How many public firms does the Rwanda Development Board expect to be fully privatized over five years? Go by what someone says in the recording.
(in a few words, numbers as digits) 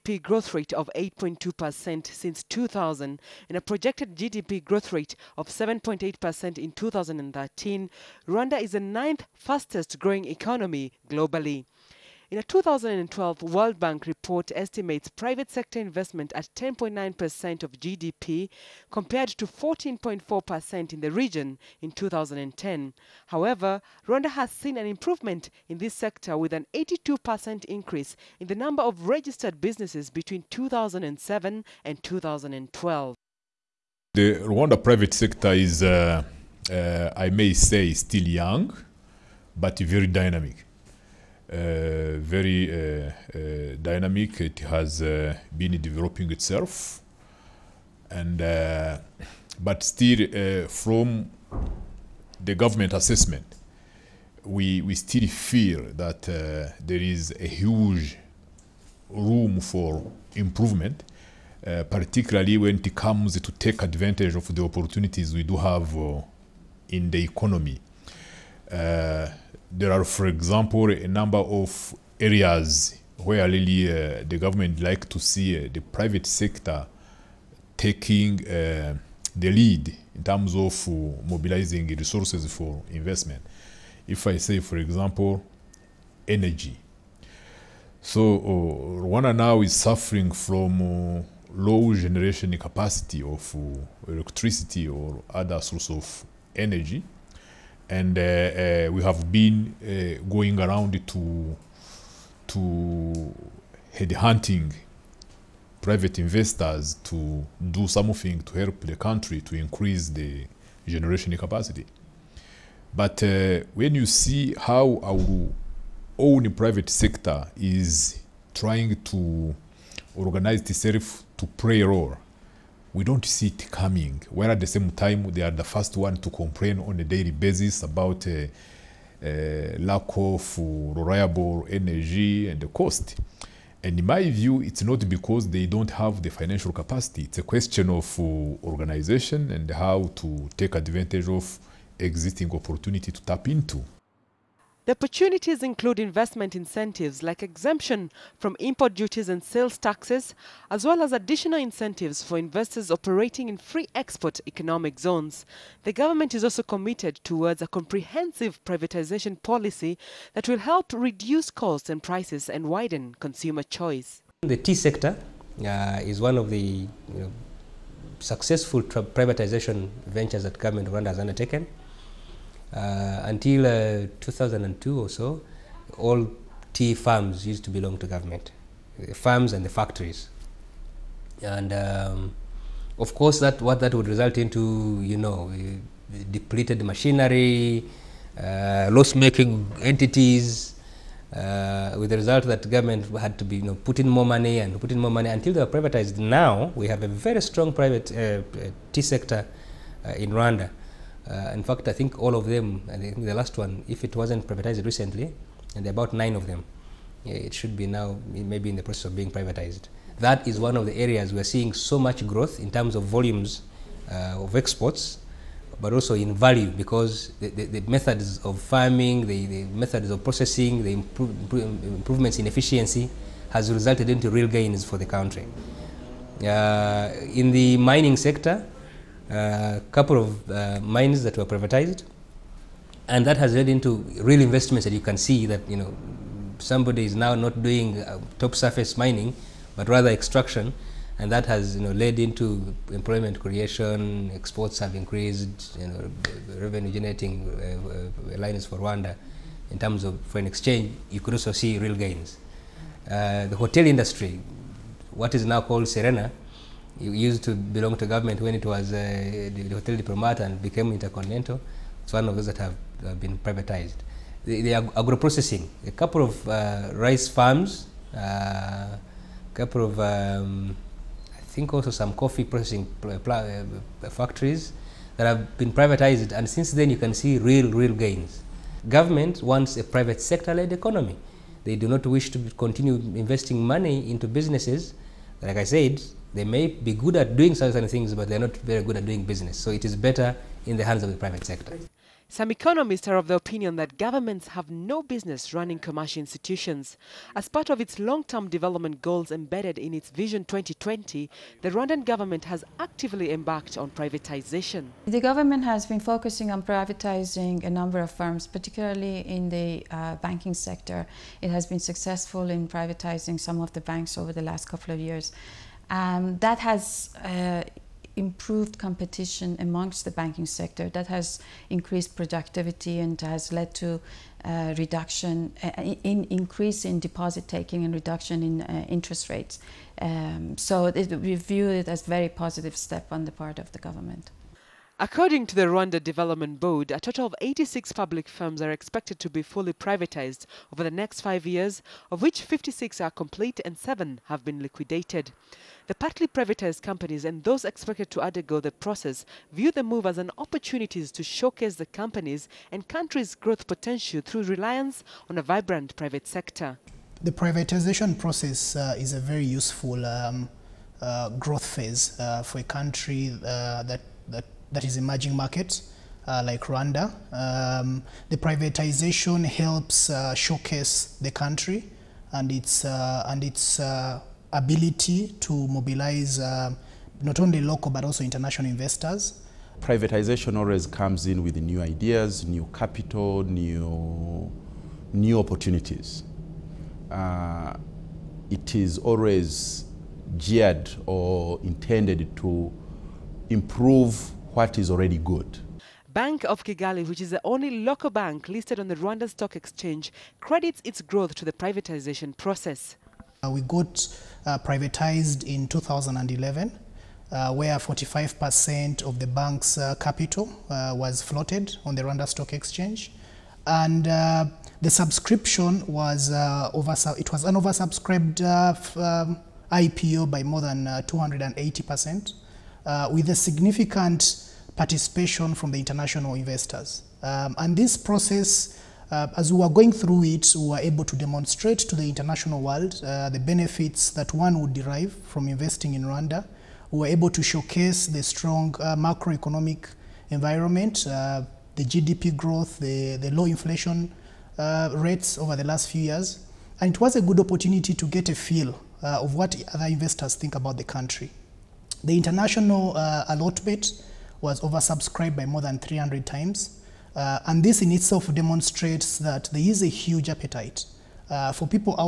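86.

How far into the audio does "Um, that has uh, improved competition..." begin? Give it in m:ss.
5:15.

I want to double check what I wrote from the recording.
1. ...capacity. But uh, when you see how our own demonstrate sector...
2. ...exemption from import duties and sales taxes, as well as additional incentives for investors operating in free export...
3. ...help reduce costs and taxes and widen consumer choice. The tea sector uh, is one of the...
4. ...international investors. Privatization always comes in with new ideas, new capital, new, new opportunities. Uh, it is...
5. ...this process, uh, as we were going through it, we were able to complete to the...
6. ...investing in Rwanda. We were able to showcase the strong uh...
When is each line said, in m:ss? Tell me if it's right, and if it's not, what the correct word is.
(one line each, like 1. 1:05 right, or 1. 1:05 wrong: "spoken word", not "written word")
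1. 1:51 wrong: "private", not "demonstrate"
2. 2:27 right
3. 2:40 wrong: "prices", not "taxes"
4. 6:18 right
5. 7:07 wrong: "demonstrate", not "complete"
6. 7:15 right.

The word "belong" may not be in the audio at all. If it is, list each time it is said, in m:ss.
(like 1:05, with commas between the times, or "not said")
2:57, 4:17.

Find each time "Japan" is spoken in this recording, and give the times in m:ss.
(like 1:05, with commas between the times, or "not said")
not said.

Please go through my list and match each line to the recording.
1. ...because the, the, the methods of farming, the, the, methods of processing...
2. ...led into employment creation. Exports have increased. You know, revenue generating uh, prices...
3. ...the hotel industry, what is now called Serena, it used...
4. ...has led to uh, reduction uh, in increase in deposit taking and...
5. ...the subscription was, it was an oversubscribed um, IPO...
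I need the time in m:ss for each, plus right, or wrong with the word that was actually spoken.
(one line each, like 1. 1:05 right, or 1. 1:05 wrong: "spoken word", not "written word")
1. 3:36 right
2. 4:01 wrong: "lines", not "prices"
3. 4:13 right
4. 5:23 right
5. 6:54 right.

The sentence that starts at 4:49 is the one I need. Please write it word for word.
So it is better in the hands of the private sector.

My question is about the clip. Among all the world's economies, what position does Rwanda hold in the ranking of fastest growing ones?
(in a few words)
ninth.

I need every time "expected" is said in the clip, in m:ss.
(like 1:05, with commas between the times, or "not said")
5:38, 5:47.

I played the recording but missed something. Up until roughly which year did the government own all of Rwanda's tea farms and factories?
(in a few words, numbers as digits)
2002.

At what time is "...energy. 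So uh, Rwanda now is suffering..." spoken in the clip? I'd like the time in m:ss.
1:26.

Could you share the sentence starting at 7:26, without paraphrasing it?
And it was a good opportunity to get a feel uh, of what other investors think about the country.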